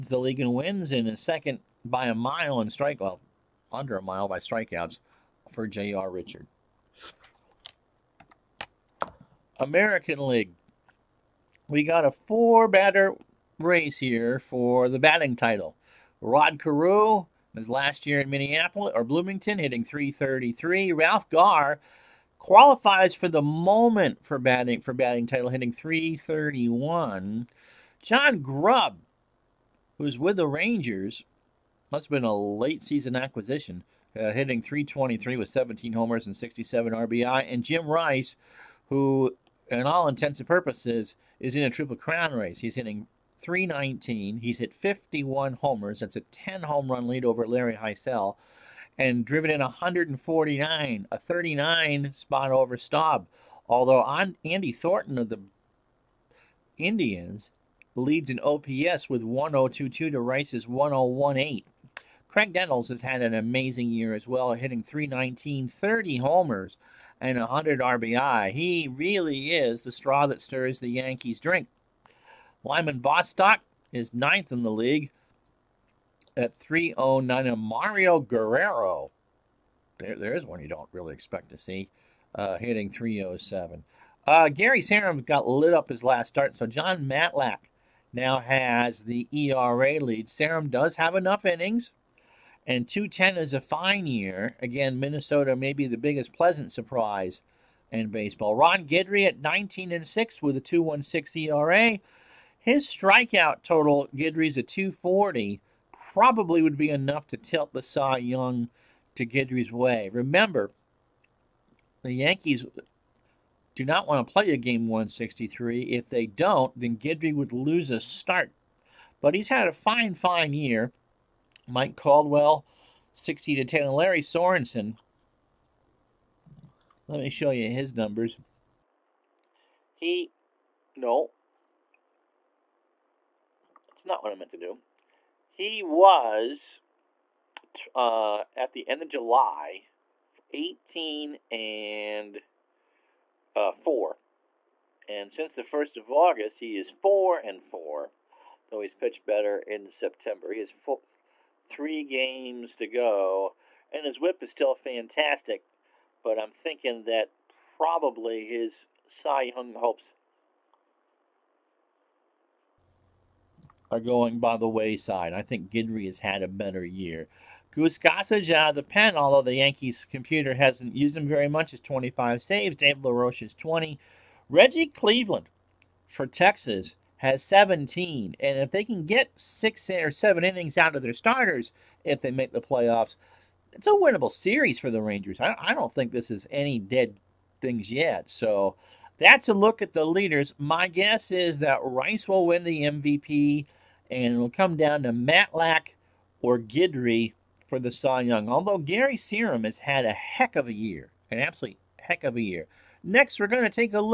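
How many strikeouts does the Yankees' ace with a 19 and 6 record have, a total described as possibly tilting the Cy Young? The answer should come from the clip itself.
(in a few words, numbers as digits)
240.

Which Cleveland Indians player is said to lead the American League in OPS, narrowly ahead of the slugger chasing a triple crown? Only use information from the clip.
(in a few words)
Andy Thornton.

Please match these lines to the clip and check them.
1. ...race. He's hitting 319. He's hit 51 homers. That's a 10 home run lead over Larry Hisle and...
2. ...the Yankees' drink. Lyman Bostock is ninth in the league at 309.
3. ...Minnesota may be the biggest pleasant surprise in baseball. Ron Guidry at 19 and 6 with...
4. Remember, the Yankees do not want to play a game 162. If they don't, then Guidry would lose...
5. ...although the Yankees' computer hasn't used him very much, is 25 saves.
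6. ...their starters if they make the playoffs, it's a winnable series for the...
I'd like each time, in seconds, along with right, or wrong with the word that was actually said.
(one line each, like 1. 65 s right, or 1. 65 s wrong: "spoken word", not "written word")
1. 42 s right
2. 70 s right
3. 94 s right
4. 110 s wrong: "163", not "162"
5. 169 s right
6. 181 s right.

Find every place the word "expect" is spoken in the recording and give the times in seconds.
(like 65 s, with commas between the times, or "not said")
81 s.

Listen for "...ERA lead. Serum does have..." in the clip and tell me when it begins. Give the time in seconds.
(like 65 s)
89 s.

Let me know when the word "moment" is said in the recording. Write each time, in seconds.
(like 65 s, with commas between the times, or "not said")
23 s.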